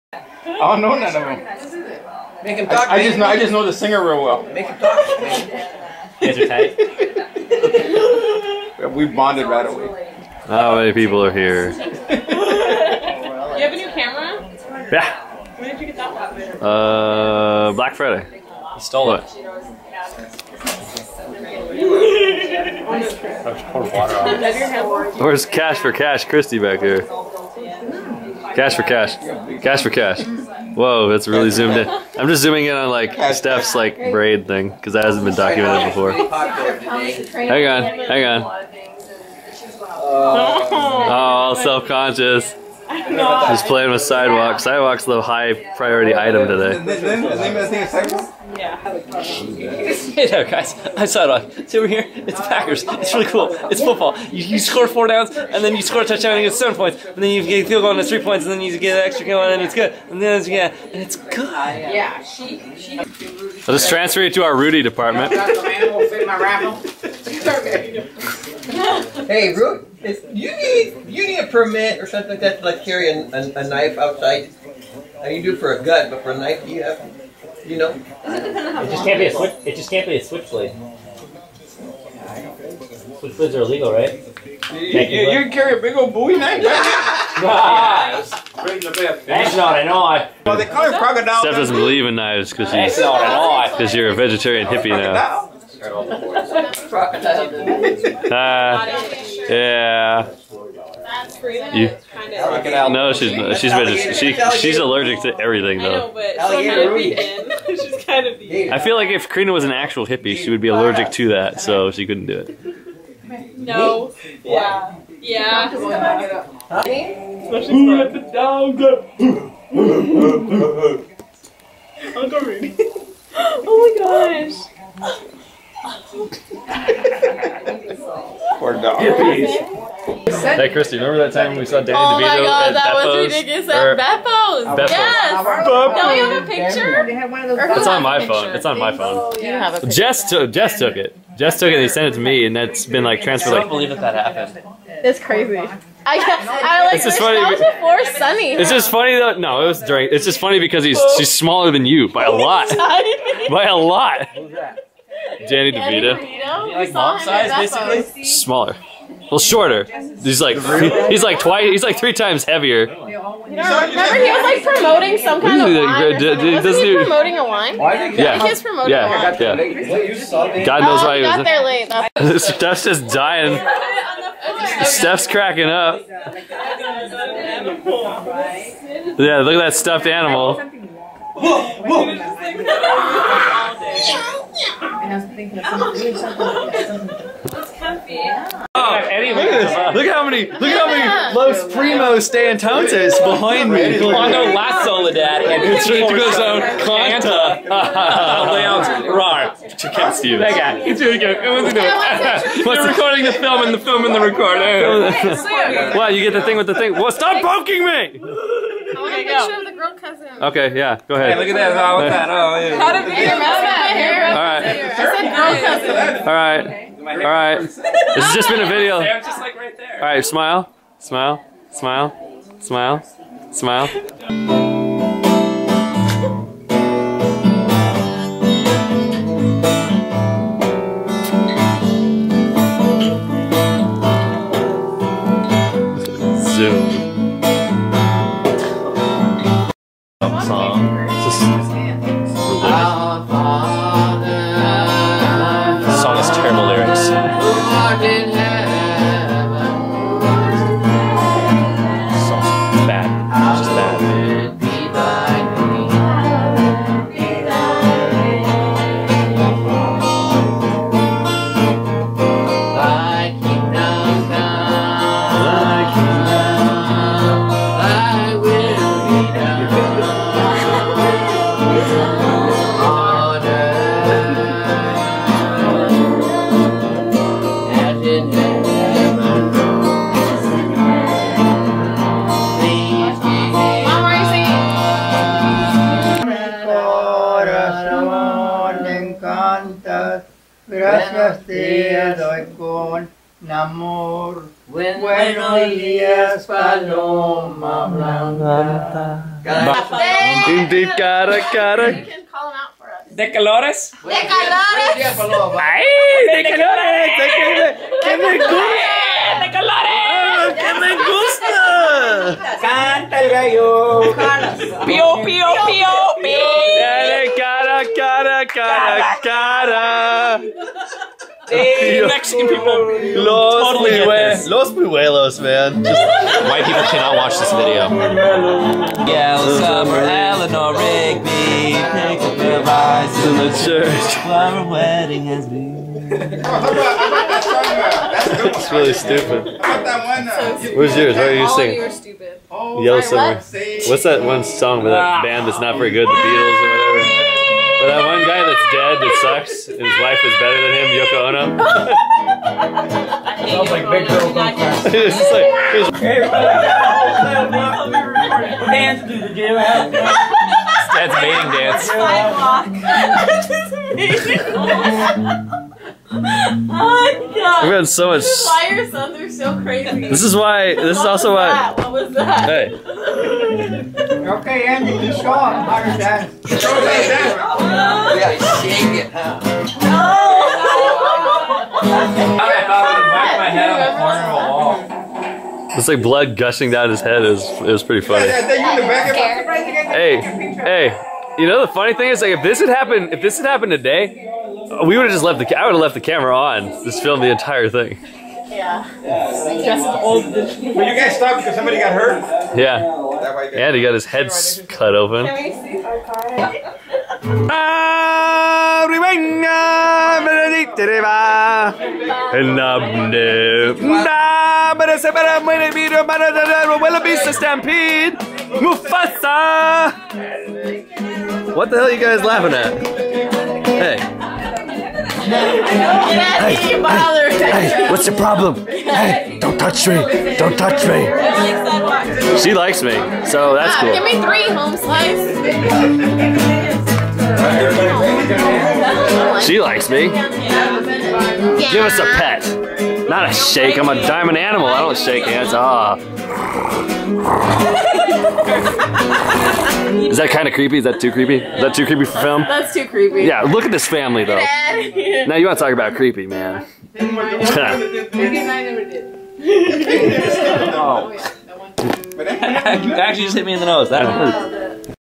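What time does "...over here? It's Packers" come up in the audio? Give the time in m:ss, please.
0:51.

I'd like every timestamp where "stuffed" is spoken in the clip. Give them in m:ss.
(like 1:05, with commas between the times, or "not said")
2:59.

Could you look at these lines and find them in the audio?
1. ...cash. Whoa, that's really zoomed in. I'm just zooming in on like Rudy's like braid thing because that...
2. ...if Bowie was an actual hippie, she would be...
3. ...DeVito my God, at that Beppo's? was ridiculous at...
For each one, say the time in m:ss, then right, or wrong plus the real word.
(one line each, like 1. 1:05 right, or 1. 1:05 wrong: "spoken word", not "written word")
1. 0:29 wrong: "Steph", not "Rudy"
2. 1:49 wrong: "Karina", not "Bowie"
3. 2:12 right.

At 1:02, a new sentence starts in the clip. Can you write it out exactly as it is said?
I'll just transfer you to our Rudy department.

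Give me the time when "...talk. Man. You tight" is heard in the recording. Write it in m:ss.
0:04.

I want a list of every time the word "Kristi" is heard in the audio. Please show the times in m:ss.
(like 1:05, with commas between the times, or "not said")
0:26, 2:10.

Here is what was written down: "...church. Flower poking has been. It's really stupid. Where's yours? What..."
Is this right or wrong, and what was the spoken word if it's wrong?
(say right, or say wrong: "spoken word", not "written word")
wrong: "wedding", not "poking".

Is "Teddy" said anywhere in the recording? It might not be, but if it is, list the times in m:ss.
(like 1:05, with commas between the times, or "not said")
not said.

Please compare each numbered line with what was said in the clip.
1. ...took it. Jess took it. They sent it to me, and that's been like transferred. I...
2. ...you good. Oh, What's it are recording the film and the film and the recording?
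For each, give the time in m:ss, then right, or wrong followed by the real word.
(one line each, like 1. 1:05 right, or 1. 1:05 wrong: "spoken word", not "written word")
1. 2:20 right
2. 3:21 right.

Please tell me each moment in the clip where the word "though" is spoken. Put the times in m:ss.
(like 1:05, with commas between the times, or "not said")
1:45, 2:29, 7:34.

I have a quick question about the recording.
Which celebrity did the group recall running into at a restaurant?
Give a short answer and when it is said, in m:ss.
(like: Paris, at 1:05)
Danny DeVito, at 2:35.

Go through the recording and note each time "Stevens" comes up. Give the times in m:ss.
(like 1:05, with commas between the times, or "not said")
3:20.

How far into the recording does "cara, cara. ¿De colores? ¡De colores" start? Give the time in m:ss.
5:00.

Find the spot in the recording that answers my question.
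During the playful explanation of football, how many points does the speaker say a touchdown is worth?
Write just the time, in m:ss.
0:56.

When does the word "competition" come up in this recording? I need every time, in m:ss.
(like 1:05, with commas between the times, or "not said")
not said.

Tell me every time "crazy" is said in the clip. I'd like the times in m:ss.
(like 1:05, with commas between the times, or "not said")
2:25, 6:09.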